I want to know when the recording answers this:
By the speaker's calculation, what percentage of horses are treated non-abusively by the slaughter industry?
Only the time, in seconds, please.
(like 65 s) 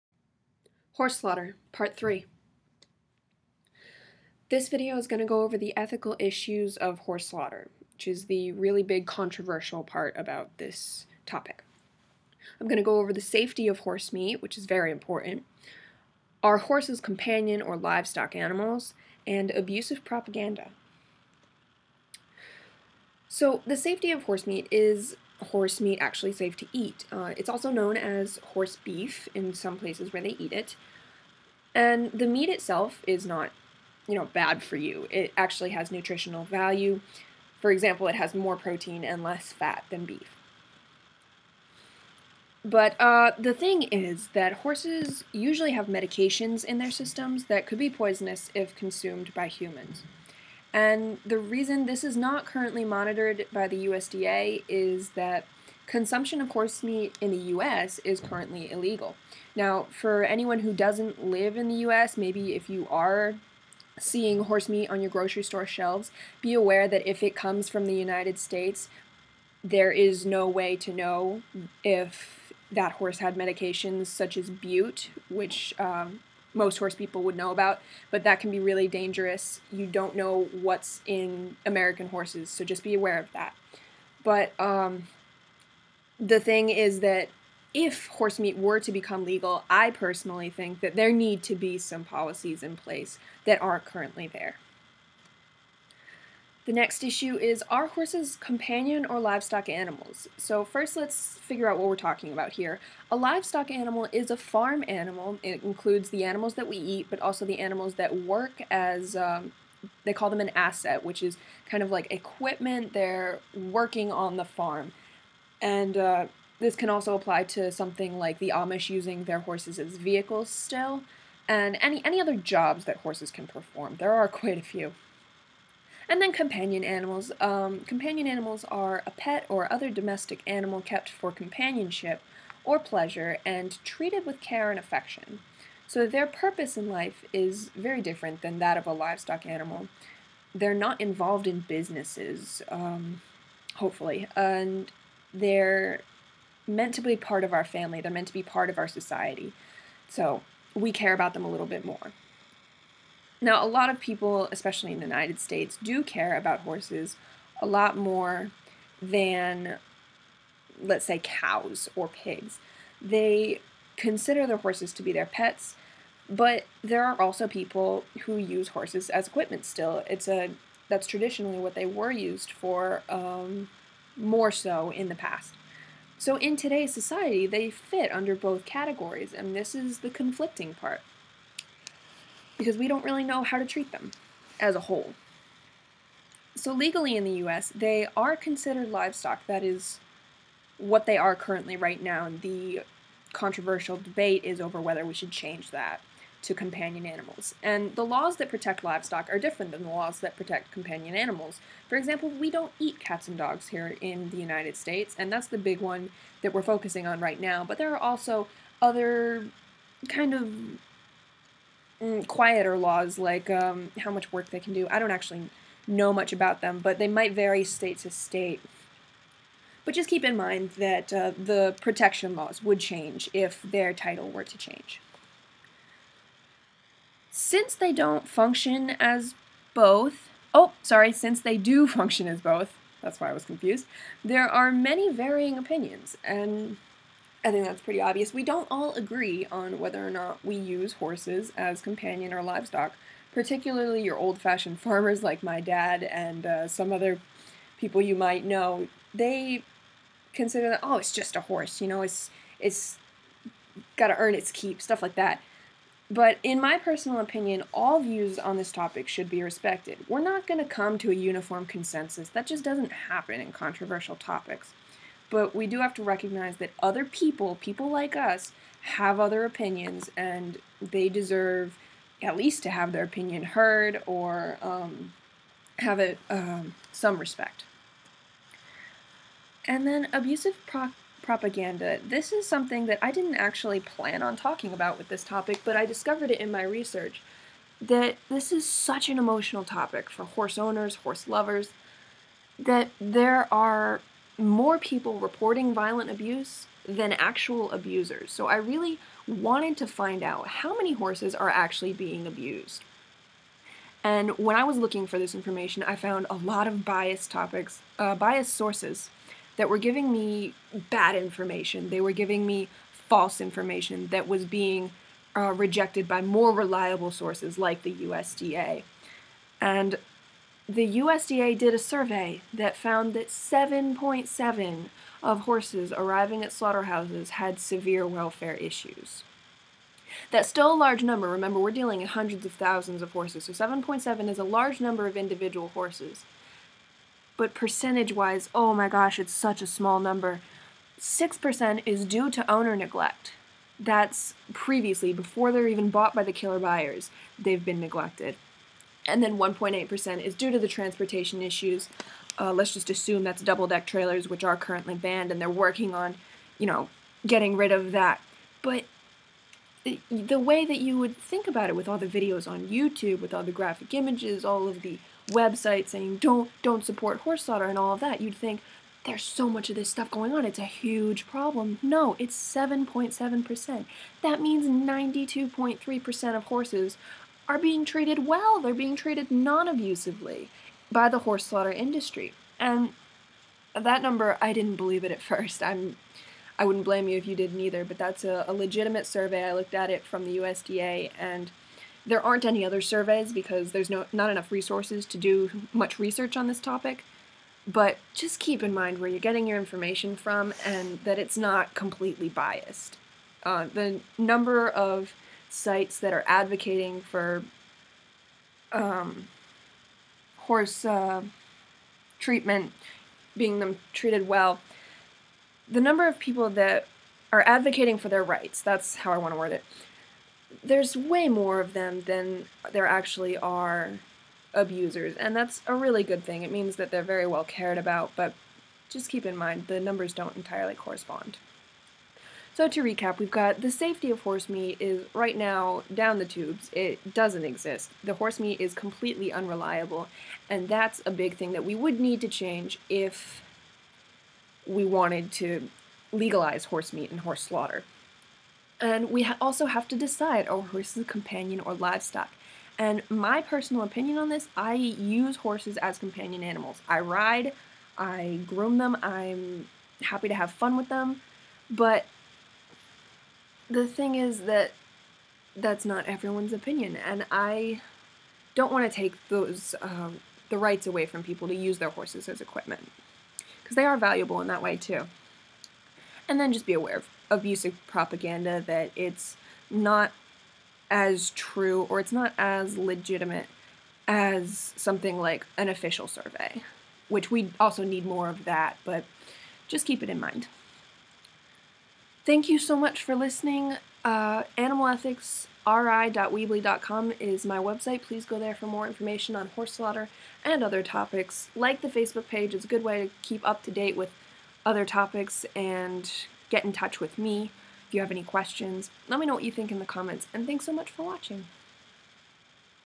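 374 s.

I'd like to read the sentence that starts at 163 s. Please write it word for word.
They consider their horses to be their pets, but there are also people who use horses as equipment still.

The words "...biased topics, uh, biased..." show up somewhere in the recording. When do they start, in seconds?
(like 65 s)
306 s.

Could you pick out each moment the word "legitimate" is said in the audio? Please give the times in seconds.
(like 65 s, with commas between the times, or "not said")
388 s, 482 s.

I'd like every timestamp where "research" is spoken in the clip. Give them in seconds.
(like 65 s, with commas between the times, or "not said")
286 s, 395 s.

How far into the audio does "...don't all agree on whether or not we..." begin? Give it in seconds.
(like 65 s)
238 s.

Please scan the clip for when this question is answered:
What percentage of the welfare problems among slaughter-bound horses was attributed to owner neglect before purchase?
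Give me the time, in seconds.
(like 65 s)
340 s.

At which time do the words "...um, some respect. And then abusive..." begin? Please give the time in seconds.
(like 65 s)
276 s.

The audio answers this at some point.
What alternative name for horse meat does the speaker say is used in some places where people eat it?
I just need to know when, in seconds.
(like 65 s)
28 s.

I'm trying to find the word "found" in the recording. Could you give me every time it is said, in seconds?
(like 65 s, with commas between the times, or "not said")
305 s, 322 s.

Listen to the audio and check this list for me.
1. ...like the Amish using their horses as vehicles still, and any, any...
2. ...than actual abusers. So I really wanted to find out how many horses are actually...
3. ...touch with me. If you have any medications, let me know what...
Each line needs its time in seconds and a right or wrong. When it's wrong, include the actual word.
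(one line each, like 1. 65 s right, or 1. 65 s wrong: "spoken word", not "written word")
1. 118 s right
2. 296 s right
3. 506 s wrong: "questions", not "medications".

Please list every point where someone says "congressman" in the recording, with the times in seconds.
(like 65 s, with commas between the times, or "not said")
not said.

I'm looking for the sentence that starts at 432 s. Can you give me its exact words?
So to recap, we've got the safety of horse meat is right now down the tubes.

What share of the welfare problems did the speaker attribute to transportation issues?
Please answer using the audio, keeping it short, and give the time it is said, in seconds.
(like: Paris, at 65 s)
1.8%, at 349 s.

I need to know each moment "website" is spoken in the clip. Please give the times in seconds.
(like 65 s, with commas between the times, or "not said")
365 s, 497 s.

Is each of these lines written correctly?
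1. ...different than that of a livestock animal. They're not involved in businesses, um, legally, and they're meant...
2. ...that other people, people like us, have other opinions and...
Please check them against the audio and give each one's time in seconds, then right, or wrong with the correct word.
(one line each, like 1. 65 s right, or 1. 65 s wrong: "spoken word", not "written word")
1. 138 s wrong: "hopefully", not "legally"
2. 266 s right.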